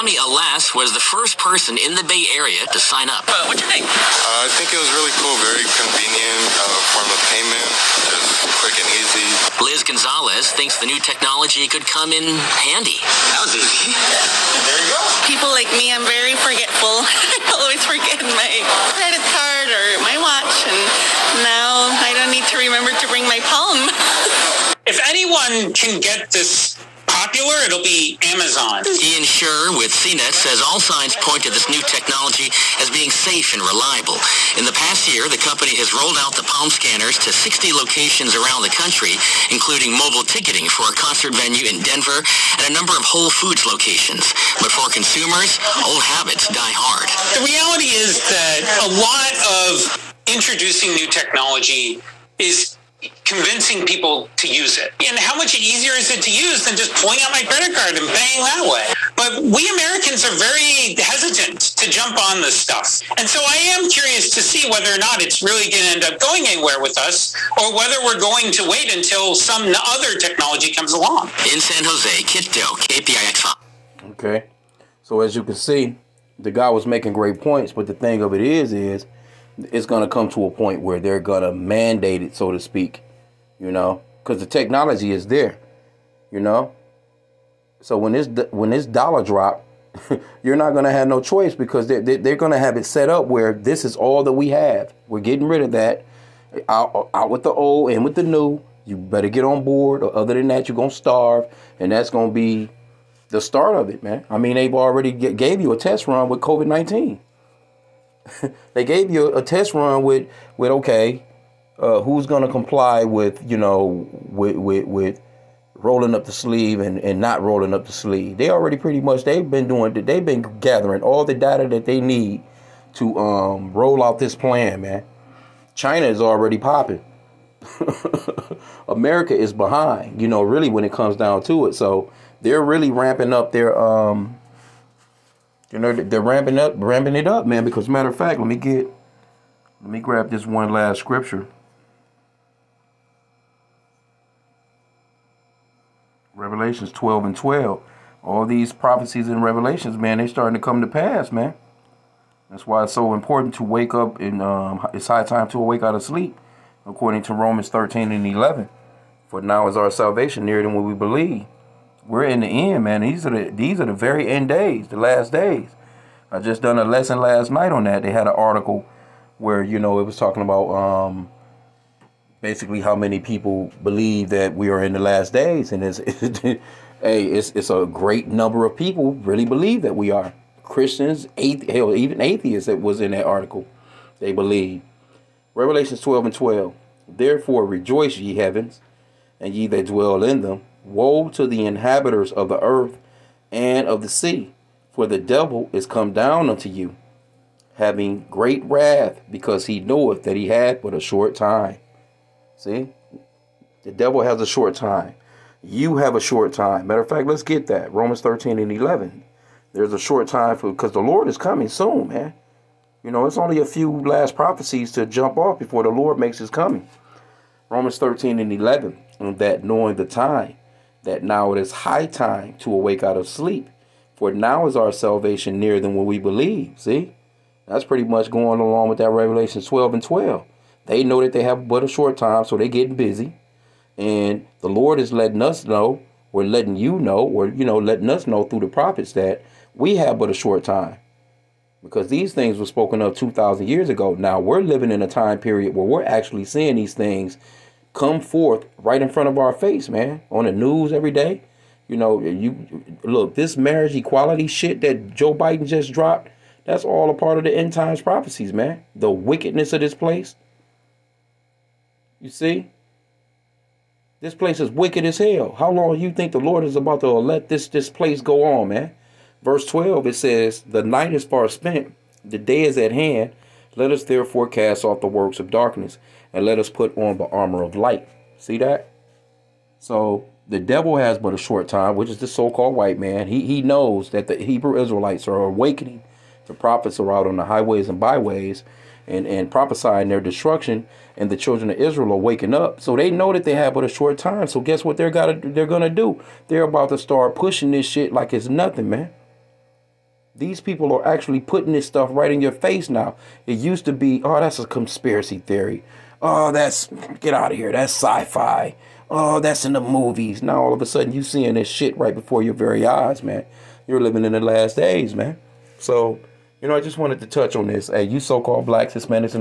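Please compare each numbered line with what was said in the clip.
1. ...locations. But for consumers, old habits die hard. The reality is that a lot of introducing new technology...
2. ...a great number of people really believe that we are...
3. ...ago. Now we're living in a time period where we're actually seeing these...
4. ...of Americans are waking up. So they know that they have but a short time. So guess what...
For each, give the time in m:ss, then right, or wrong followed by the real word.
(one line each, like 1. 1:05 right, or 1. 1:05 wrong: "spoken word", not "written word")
1. 0:43 right
2. 2:57 right
3. 4:03 right
4. 4:51 wrong: "Israel", not "Americans".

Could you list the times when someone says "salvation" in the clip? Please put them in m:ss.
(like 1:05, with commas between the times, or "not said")
2:39, 3:44.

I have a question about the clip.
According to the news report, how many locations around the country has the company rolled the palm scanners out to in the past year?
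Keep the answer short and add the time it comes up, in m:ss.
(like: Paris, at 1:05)
60, at 0:37.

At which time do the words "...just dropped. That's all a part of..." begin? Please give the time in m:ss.
4:15.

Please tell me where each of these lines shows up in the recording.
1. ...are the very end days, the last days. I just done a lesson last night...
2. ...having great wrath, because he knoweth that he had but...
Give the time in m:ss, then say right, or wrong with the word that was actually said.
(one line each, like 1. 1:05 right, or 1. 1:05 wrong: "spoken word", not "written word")
1. 2:43 right
2. 3:17 right.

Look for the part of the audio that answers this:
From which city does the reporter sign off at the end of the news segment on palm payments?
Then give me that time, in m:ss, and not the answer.
1:11.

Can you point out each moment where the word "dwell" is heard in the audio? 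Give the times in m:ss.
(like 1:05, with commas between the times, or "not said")
3:09.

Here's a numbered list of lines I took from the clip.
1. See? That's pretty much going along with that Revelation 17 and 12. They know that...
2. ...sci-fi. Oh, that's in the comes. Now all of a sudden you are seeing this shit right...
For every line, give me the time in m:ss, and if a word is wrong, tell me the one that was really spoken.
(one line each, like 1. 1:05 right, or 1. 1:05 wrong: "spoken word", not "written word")
1. 3:46 wrong: "12", not "17"
2. 5:07 wrong: "movies", not "comes".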